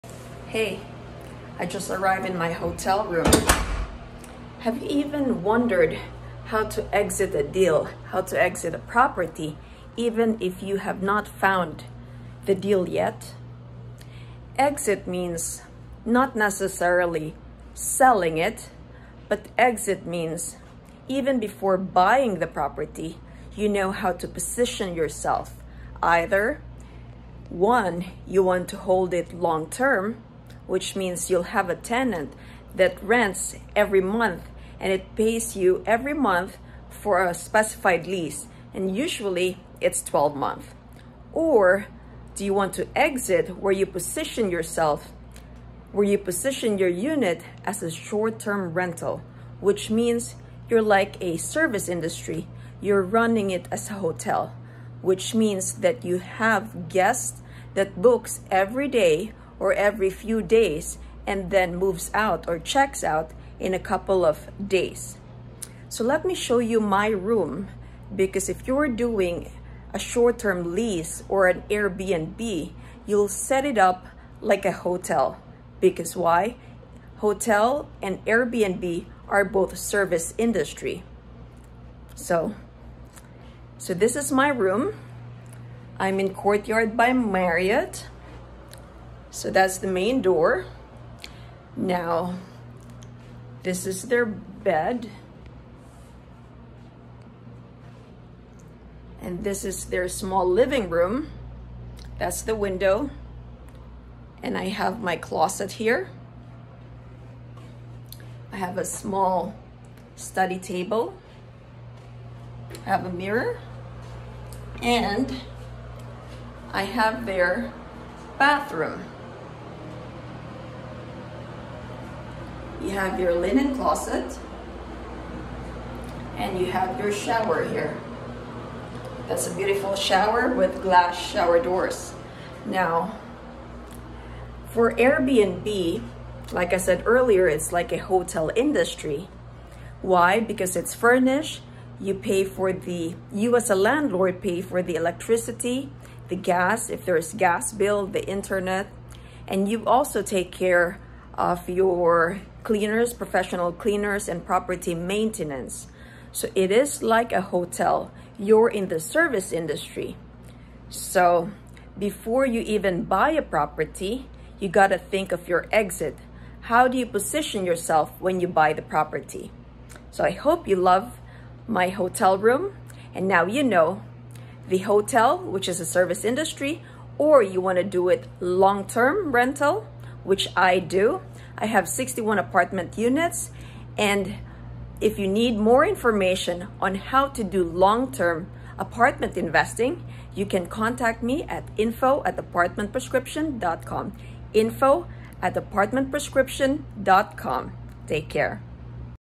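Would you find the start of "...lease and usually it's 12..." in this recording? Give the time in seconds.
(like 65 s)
38 s.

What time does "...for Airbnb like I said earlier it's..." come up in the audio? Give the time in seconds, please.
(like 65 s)
134 s.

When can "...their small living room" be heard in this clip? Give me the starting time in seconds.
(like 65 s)
99 s.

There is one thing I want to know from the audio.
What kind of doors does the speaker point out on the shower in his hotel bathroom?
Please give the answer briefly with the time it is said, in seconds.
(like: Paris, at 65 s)
Glass shower doors, at 130 s.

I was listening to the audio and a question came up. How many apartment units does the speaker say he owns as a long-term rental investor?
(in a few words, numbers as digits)
61.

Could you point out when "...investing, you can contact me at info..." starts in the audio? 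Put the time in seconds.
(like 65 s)
189 s.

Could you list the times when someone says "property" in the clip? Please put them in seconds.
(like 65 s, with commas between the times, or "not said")
8 s, 22 s, 154 s, 163 s, 168 s.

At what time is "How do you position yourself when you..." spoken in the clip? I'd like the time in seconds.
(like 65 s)
166 s.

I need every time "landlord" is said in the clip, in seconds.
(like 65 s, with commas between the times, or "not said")
143 s.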